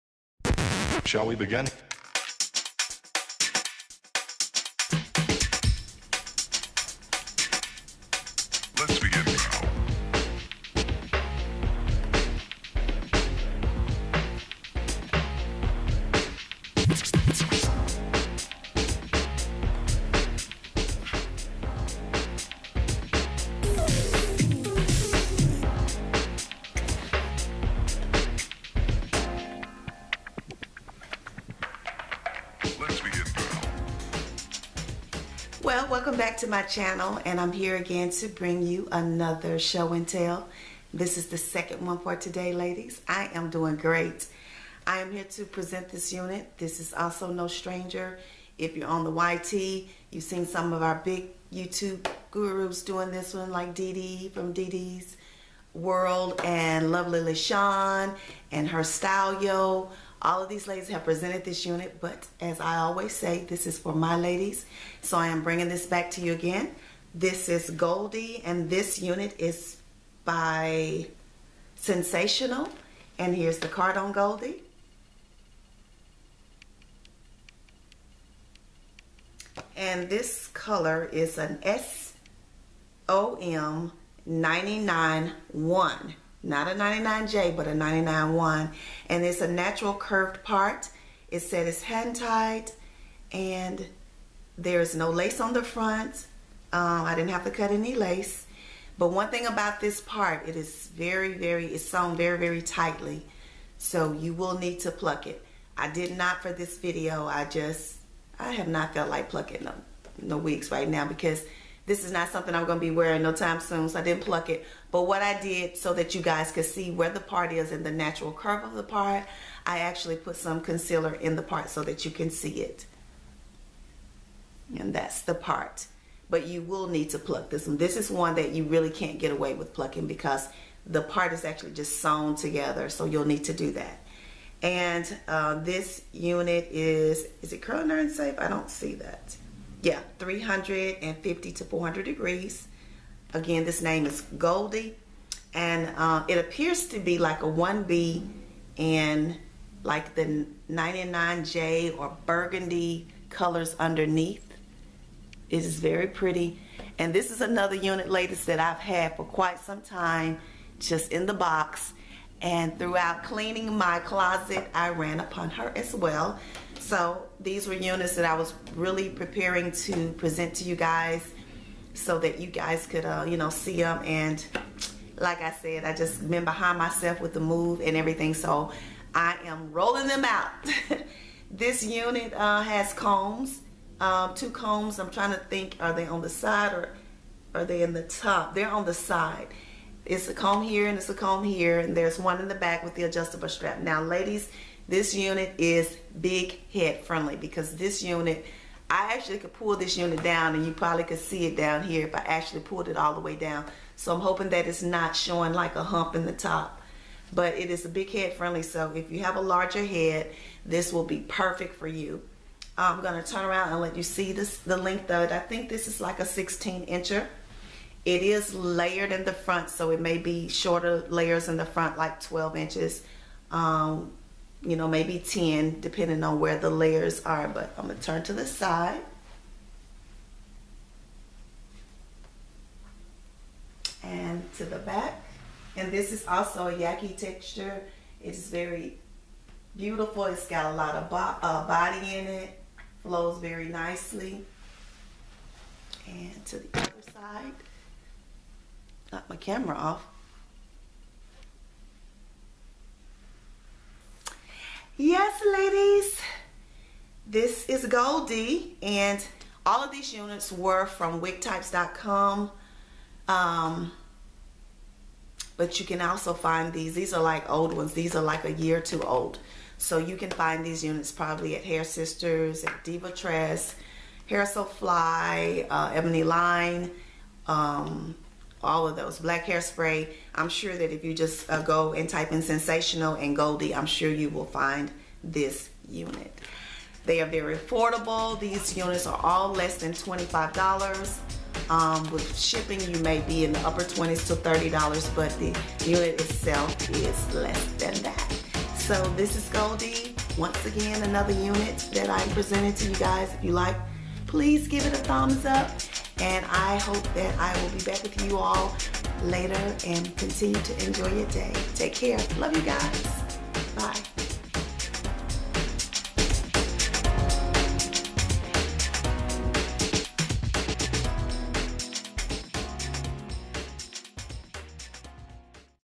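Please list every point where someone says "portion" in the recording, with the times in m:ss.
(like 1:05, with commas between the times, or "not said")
not said.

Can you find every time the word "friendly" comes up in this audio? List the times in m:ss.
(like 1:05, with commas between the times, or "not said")
3:17, 3:28.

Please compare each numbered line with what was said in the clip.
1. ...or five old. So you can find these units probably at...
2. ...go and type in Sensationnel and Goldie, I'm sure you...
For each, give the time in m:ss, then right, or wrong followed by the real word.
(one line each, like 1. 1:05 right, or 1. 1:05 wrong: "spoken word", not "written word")
1. 4:28 wrong: "two", not "five"
2. 4:41 right.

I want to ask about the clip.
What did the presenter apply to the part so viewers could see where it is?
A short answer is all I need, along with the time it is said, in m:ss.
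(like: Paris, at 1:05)
concealer, at 2:00.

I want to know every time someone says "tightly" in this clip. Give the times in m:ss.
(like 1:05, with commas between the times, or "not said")
1:42.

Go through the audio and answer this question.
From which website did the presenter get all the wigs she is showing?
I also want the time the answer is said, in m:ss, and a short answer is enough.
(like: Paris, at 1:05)
wigtypes.com, at 4:21.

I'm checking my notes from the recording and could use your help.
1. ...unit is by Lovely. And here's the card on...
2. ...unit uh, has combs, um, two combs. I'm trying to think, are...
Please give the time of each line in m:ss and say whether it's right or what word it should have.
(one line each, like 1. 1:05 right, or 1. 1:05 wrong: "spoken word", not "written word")
1. 1:09 wrong: "Sensationnel", not "Lovely"
2. 3:01 right.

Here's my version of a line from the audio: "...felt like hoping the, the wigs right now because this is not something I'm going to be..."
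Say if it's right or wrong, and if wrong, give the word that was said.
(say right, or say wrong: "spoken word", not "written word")
wrong: "plucking", not "hoping".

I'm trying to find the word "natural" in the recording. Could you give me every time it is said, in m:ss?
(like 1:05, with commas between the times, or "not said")
1:29, 1:57.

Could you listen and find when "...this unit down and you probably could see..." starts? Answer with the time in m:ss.
3:19.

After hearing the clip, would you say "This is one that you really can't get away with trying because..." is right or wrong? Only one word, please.
wrong.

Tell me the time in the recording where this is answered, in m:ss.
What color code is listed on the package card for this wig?
1:23.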